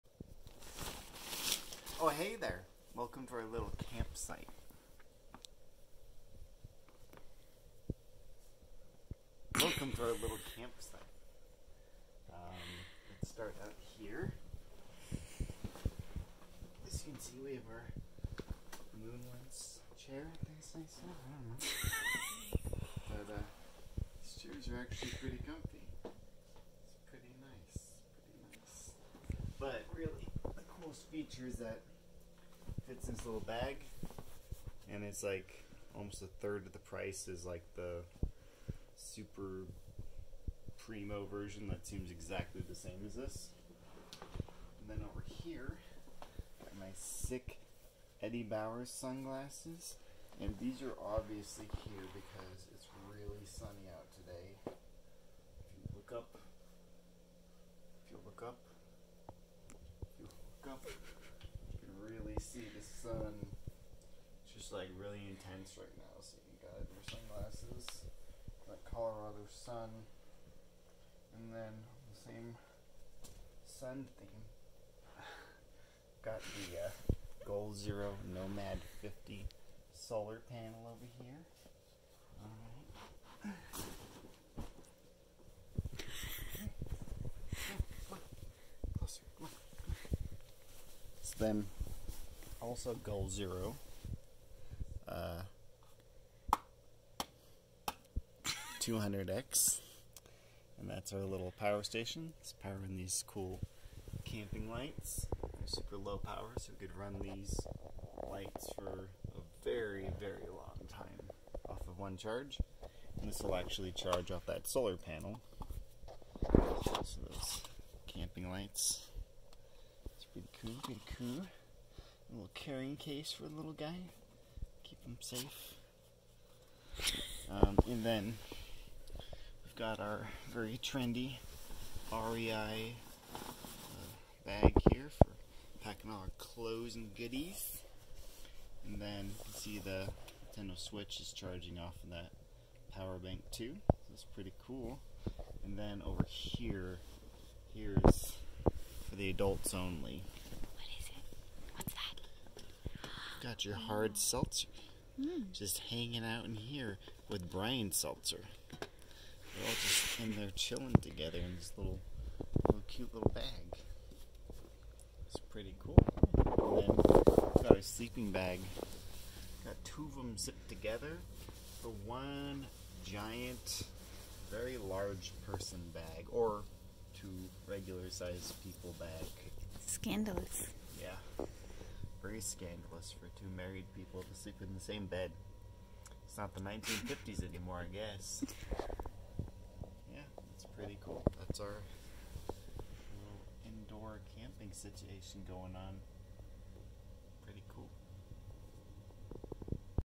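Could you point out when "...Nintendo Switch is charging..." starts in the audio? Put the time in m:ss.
2:20.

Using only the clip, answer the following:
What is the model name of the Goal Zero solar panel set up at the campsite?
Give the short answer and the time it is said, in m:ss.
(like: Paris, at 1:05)
Nomad 50, at 1:18.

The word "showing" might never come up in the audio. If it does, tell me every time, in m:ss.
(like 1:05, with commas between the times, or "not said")
not said.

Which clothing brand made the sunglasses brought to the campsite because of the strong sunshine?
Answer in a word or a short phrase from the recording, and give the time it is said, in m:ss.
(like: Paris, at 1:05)
Eddie Bauer, at 0:48.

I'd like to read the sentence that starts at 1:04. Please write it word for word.
It's just like really intense right now, so you gotta your sunglasses.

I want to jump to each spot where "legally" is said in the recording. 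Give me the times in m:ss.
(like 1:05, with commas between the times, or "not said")
not said.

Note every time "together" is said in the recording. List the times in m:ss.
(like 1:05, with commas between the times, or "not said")
2:41, 2:50.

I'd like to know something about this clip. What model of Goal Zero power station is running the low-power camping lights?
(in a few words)
200X.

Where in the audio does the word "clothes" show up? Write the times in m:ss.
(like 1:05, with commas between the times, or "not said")
2:16.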